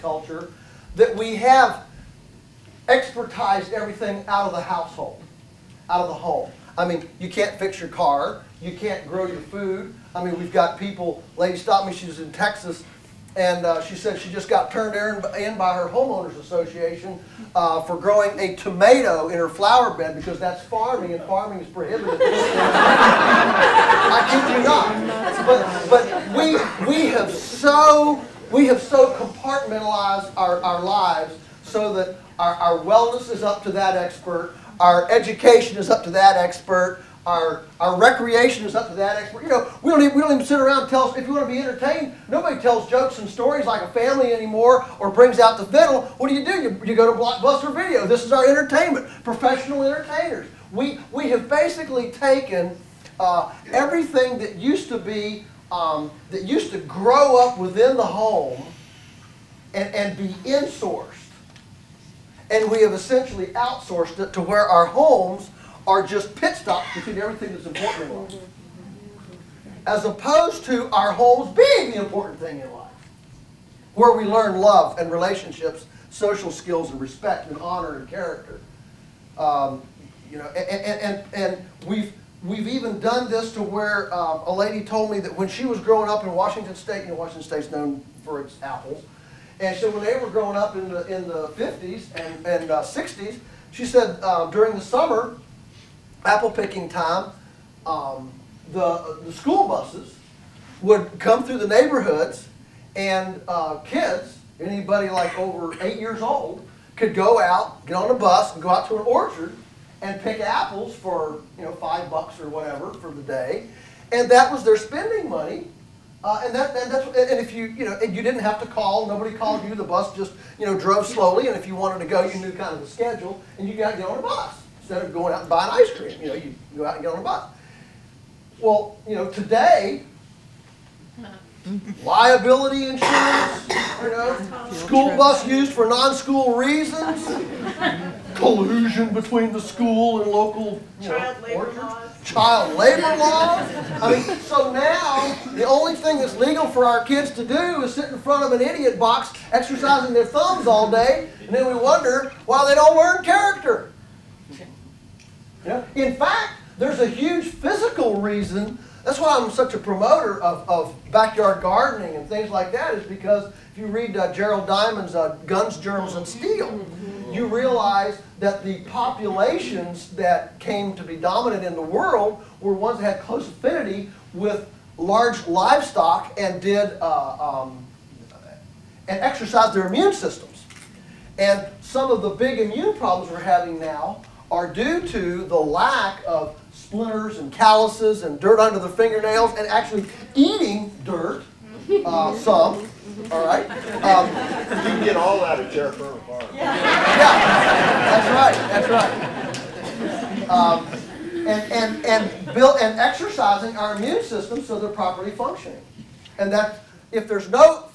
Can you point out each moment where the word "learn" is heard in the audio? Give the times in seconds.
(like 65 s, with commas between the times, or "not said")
74 s, 152 s.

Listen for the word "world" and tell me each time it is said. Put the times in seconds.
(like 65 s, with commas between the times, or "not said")
171 s.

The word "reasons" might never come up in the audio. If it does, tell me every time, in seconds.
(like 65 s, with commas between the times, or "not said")
136 s, 158 s.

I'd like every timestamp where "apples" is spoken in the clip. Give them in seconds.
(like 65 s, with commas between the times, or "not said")
88 s, 96 s, 110 s.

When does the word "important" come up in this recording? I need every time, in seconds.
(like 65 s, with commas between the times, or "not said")
67 s, 71 s.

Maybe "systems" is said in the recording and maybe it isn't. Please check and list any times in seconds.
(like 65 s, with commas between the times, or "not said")
180 s, 204 s.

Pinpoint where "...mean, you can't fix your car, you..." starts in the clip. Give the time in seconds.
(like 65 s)
6 s.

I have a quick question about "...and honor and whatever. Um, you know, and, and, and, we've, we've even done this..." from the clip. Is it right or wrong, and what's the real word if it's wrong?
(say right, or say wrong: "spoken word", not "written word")
wrong: "character", not "whatever".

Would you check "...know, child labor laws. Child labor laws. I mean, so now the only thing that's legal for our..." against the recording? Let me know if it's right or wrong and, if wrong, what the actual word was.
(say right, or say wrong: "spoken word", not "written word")
right.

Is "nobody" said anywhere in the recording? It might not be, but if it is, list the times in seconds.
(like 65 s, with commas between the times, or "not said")
42 s, 119 s.